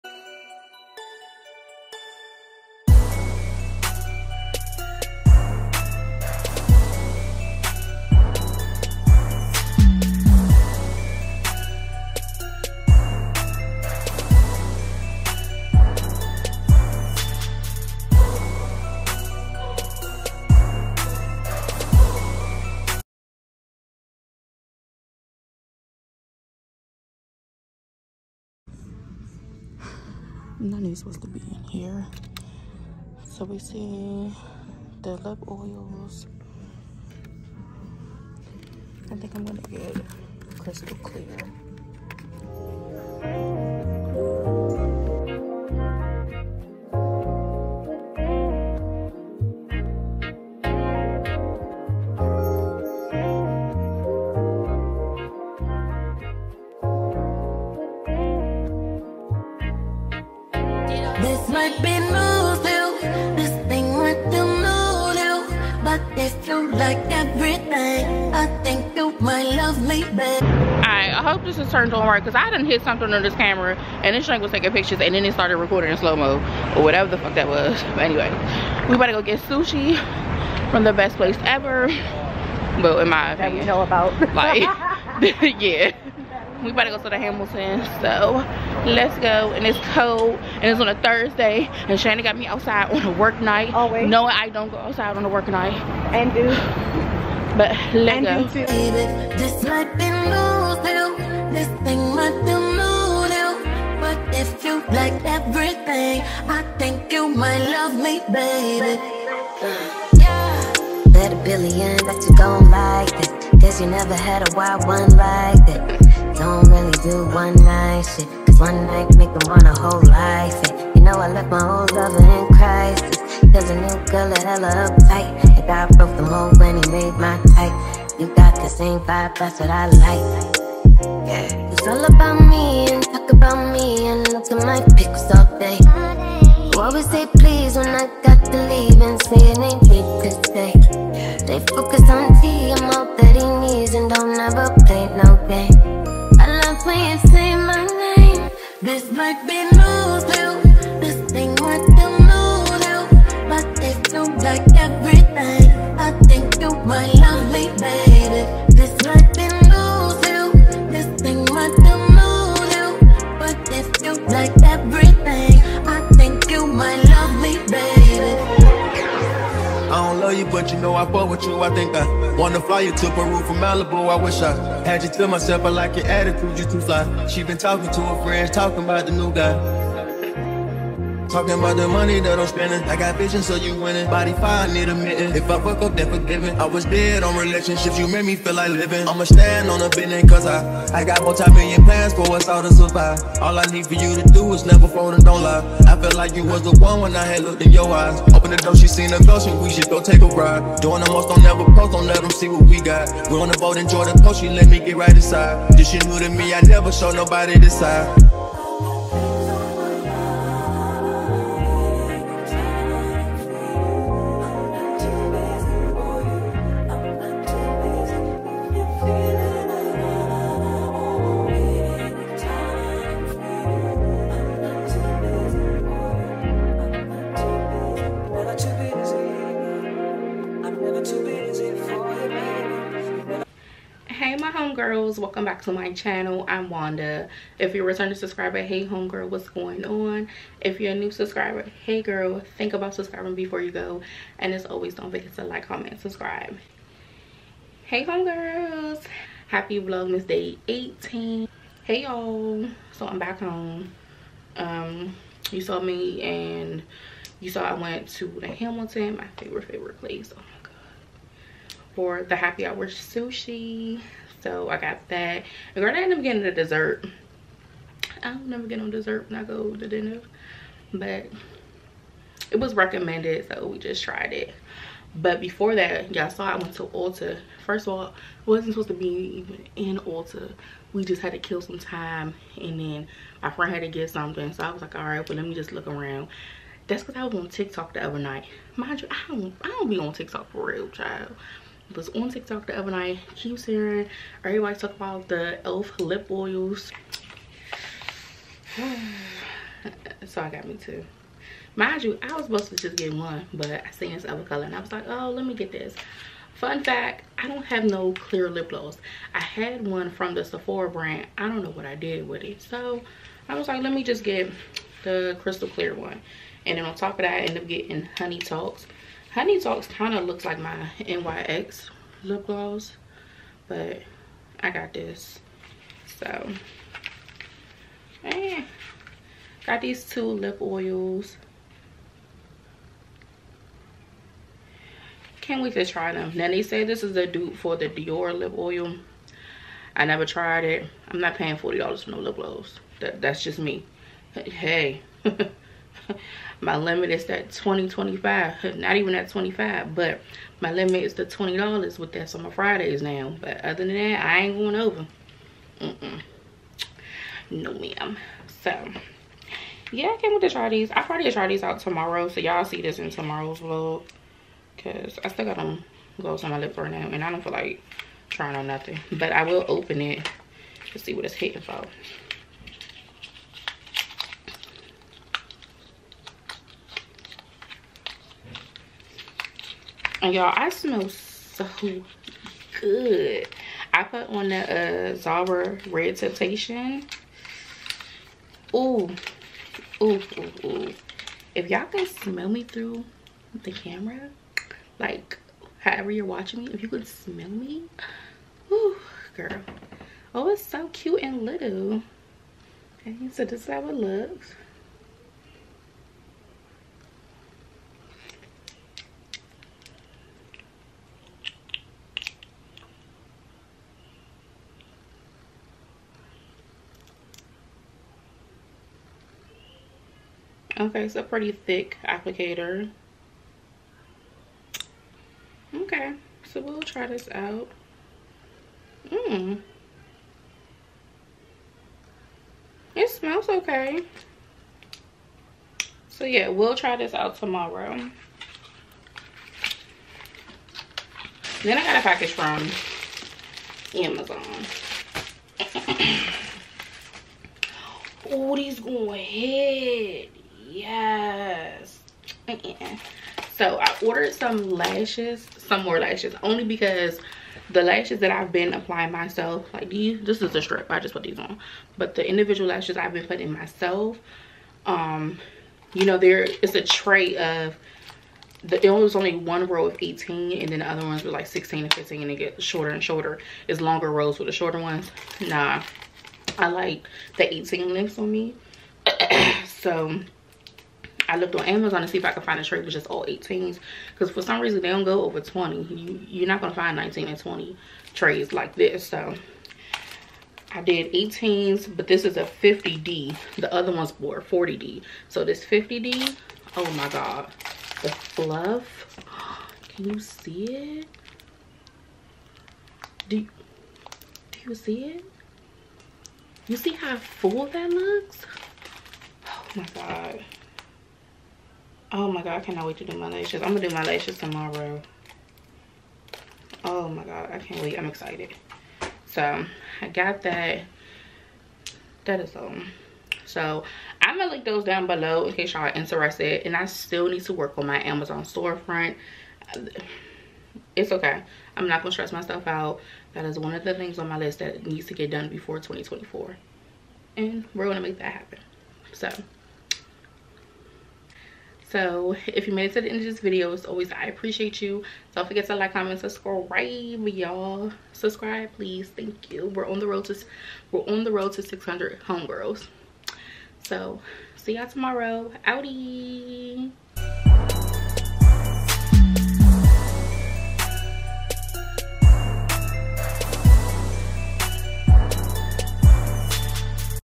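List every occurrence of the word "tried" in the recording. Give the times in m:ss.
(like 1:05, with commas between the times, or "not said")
4:34, 5:40.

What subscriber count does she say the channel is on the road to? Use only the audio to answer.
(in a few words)
600.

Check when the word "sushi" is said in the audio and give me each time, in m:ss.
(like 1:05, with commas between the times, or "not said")
1:19, 4:22.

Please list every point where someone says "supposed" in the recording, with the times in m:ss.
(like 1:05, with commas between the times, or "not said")
0:30, 4:38, 5:02.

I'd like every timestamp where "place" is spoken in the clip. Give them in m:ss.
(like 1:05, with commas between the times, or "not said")
1:21, 4:19.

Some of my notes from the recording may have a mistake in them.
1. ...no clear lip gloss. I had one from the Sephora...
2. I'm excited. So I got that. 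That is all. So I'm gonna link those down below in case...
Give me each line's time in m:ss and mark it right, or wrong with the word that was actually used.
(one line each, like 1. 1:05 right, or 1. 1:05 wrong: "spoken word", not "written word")
1. 5:07 right
2. 8:37 right.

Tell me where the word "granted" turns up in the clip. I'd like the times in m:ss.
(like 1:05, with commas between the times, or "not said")
4:25.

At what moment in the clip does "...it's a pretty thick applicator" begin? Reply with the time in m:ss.
7:01.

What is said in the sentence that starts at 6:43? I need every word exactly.
Okay, so this is how it looks.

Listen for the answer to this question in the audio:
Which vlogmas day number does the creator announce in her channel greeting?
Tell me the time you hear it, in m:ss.
4:09.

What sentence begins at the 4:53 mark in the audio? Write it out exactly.
Keeps hearing everybody talk about the e.l.f.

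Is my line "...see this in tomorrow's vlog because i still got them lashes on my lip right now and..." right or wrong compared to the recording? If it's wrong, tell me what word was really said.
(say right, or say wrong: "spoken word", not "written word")
wrong: "gloves", not "lashes".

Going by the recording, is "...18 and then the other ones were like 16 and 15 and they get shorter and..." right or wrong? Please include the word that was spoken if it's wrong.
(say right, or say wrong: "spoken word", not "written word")
right.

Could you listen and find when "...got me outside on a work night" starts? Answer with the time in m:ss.
1:32.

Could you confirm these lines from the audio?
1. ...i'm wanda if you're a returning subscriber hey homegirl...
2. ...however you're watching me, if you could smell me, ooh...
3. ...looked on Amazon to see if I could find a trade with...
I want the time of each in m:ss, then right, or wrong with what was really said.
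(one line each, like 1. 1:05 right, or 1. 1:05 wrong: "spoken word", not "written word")
1. 3:56 right
2. 6:35 right
3. 8:01 right.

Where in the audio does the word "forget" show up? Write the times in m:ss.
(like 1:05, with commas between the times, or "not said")
4:05, 9:05.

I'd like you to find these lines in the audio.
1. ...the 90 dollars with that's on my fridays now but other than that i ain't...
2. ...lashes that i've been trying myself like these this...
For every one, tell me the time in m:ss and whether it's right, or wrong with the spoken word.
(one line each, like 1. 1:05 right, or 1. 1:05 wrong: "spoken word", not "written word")
1. 5:51 wrong: "20", not "90"
2. 7:37 wrong: "applying", not "trying".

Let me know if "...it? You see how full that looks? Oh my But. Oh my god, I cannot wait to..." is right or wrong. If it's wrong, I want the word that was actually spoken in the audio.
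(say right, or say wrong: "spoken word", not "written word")
wrong: "God", not "But".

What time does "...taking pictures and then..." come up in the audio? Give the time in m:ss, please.
1:14.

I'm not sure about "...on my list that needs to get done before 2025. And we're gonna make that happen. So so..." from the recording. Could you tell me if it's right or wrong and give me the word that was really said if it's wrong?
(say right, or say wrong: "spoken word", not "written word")
wrong: "2024", not "2025".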